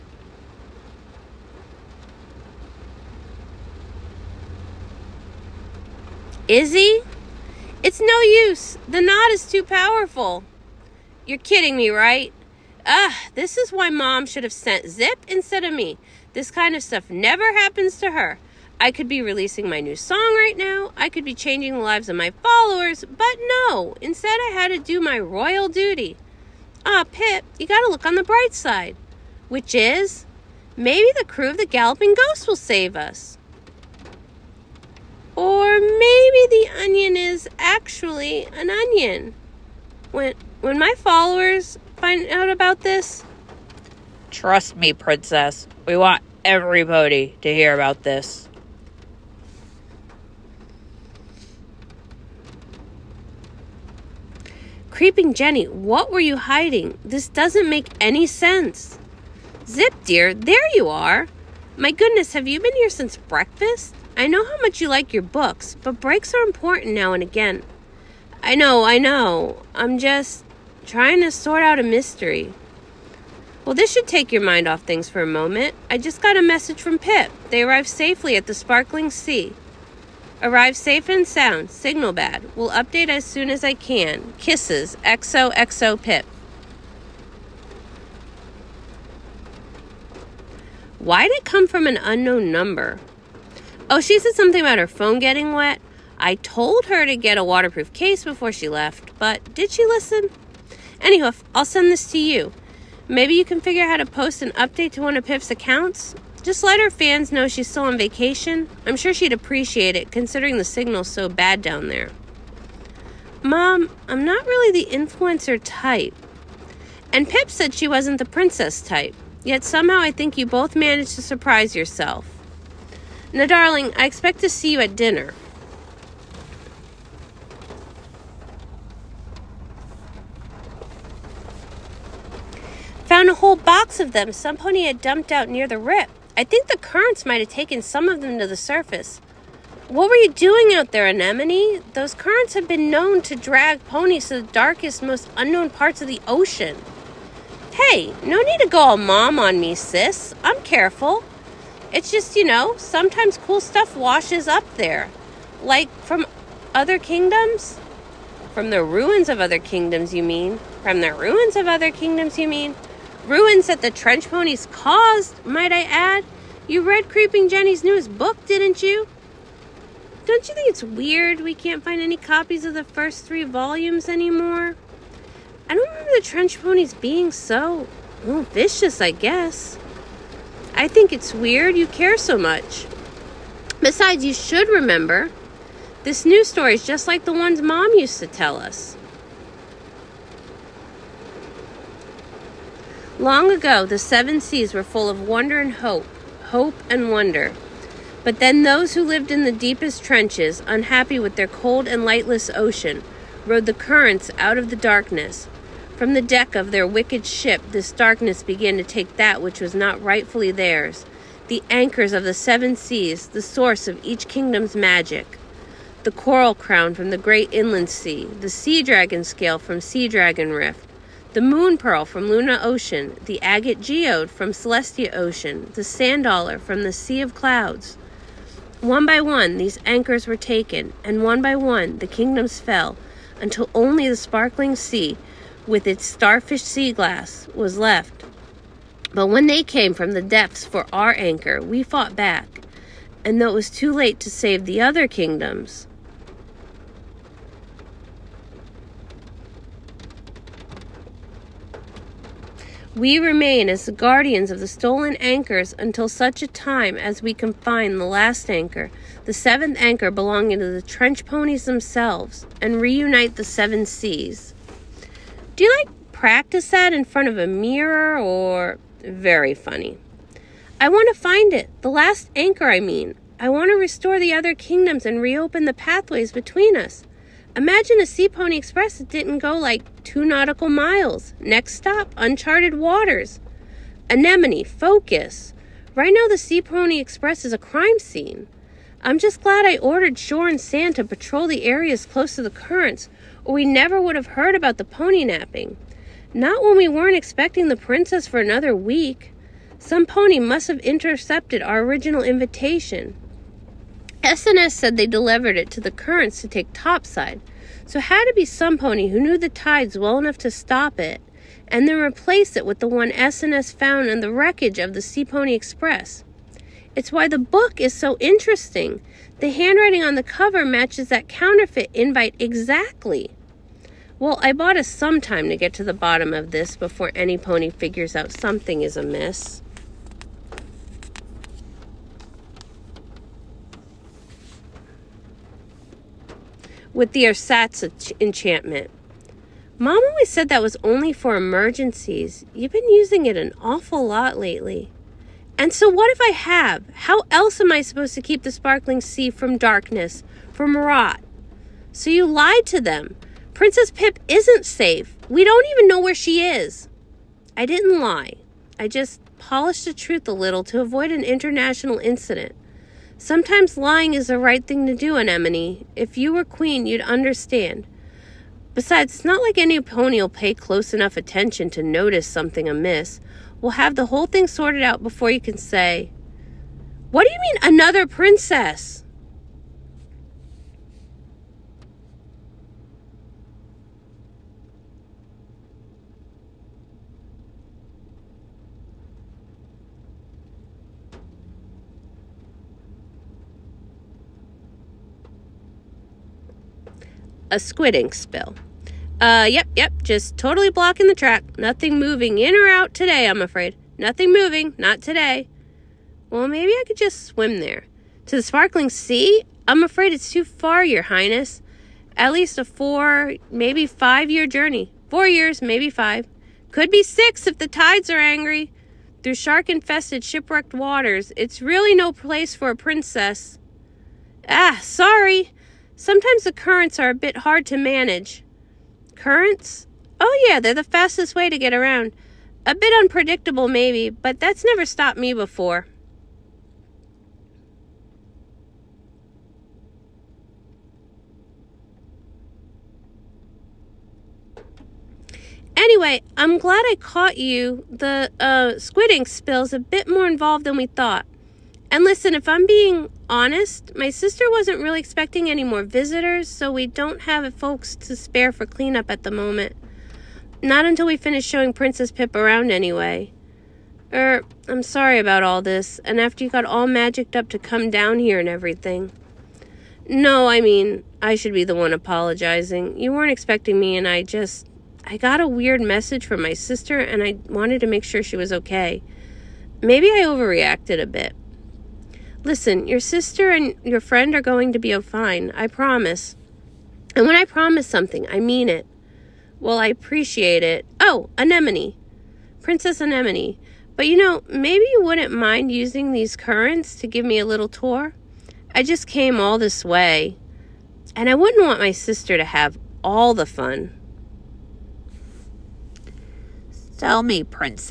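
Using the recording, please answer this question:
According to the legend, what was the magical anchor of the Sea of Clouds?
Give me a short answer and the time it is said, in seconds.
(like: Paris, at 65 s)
sand dollar, at 225 s.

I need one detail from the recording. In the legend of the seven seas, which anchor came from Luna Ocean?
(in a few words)
moon pearl.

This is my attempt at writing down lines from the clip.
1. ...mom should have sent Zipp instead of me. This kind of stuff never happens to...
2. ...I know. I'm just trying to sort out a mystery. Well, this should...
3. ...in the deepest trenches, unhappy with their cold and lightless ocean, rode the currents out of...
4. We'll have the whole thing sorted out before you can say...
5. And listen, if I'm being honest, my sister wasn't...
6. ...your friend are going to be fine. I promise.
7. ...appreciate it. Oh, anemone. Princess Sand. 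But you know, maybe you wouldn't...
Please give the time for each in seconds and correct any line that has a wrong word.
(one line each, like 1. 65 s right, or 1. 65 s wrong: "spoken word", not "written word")
1. 13 s right
2. 68 s right
3. 199 s right
4. 373 s right
5. 451 s right
6. 483 s right
7. 489 s wrong: "Anemone", not "Sand".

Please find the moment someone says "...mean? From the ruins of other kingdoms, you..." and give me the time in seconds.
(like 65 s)
160 s.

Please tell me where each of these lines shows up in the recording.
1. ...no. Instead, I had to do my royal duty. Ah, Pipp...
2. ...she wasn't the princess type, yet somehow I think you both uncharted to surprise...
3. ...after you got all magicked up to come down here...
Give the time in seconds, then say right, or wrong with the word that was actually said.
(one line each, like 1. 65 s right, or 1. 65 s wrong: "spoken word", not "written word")
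1. 23 s right
2. 117 s wrong: "managed", not "uncharted"
3. 466 s right.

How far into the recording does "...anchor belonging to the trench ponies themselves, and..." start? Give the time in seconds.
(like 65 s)
259 s.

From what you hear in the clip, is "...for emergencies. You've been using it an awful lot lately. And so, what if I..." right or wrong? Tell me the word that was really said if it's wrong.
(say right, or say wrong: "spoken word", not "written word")
right.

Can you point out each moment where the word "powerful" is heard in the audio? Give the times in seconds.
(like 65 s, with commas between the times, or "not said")
9 s.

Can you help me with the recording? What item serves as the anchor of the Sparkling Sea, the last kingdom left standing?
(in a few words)
starfish sea glass.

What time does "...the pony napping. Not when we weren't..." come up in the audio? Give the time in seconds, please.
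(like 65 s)
294 s.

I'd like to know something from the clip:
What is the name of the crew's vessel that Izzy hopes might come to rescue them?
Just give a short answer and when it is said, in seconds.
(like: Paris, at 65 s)
Galloping Ghost, at 31 s.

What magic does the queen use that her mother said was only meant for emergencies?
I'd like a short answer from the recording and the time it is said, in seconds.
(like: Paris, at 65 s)
ersatz enchantment, at 337 s.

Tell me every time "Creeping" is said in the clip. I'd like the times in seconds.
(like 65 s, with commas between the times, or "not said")
54 s, 167 s.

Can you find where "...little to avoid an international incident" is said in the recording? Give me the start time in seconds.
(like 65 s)
360 s.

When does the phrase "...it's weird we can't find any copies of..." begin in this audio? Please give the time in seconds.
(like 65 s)
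170 s.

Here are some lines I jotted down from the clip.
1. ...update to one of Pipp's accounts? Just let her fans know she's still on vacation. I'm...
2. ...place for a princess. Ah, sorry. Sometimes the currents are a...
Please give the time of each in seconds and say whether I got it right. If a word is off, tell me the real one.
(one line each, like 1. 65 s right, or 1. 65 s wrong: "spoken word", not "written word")
1. 104 s right
2. 422 s right.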